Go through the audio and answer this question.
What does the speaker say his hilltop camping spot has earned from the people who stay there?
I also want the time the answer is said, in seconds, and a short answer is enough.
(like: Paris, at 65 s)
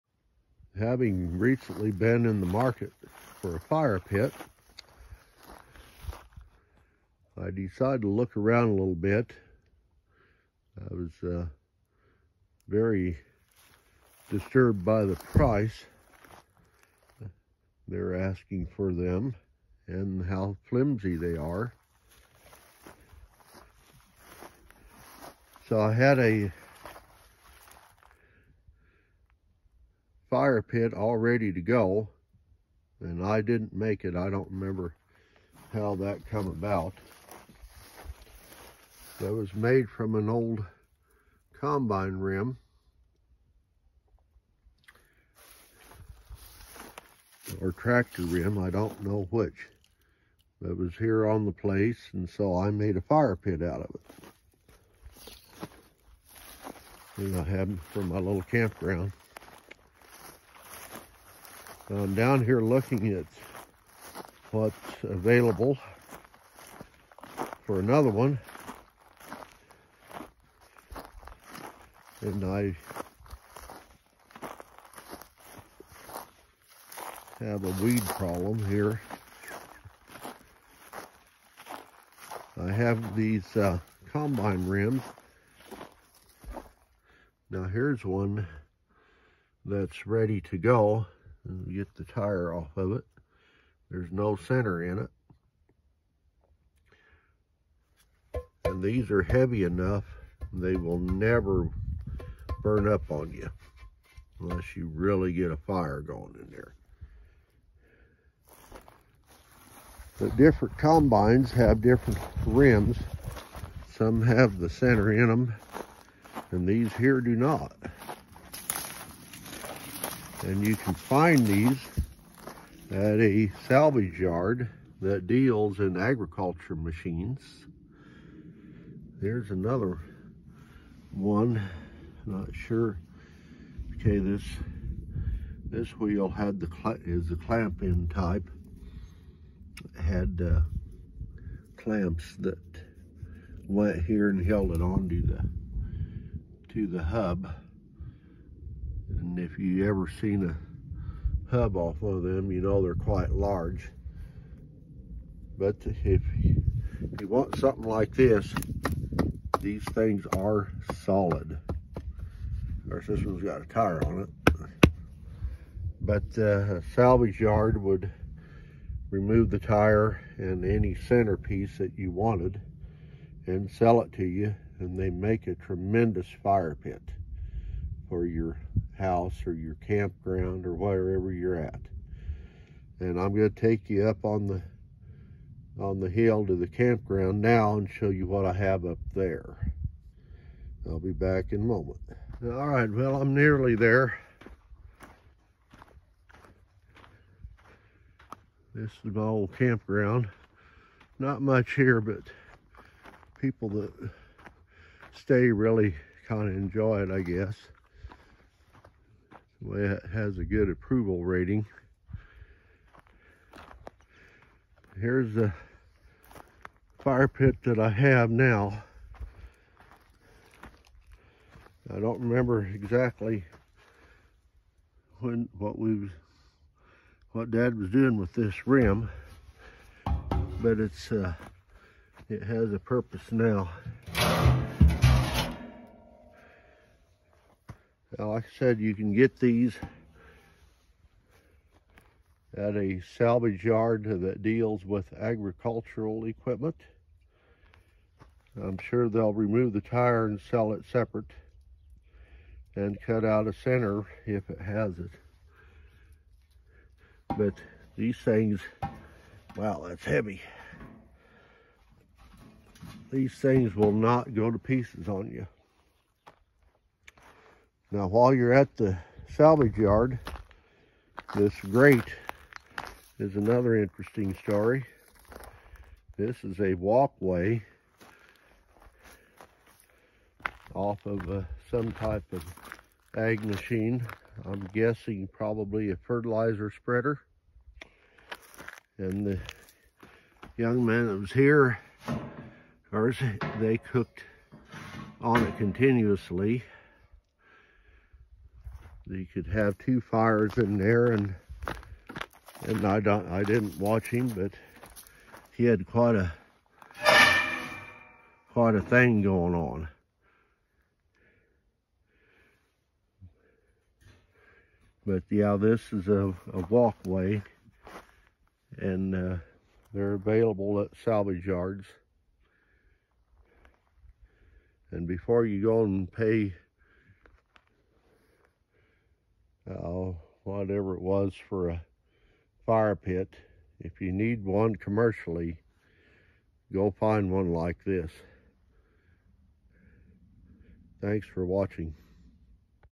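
Good approval rating, at 210 s.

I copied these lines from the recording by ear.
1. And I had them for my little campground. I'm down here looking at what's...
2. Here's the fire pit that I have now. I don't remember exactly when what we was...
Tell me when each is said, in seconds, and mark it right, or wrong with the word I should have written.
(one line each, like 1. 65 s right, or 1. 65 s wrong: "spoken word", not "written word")
1. 57 s right
2. 214 s right.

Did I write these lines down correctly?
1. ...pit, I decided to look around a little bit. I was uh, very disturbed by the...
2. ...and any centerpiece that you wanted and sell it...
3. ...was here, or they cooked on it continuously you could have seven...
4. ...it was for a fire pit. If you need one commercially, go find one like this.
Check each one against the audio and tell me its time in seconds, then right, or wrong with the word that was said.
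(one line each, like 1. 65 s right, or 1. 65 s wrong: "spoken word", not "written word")
1. 3 s right
2. 170 s right
3. 291 s wrong: "two", not "seven"
4. 330 s right.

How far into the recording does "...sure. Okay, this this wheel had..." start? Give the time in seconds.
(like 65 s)
132 s.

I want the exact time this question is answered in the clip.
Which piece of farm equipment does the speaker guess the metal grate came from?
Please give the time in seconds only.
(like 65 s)
285 s.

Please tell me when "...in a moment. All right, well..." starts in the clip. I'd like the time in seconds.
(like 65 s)
191 s.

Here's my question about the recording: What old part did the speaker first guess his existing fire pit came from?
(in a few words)
Combine rim.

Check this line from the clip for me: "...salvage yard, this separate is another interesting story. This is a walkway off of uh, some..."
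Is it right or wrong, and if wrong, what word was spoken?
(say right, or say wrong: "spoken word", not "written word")
wrong: "grate", not "separate".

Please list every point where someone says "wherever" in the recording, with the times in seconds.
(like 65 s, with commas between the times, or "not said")
180 s.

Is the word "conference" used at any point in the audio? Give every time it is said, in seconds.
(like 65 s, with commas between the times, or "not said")
not said.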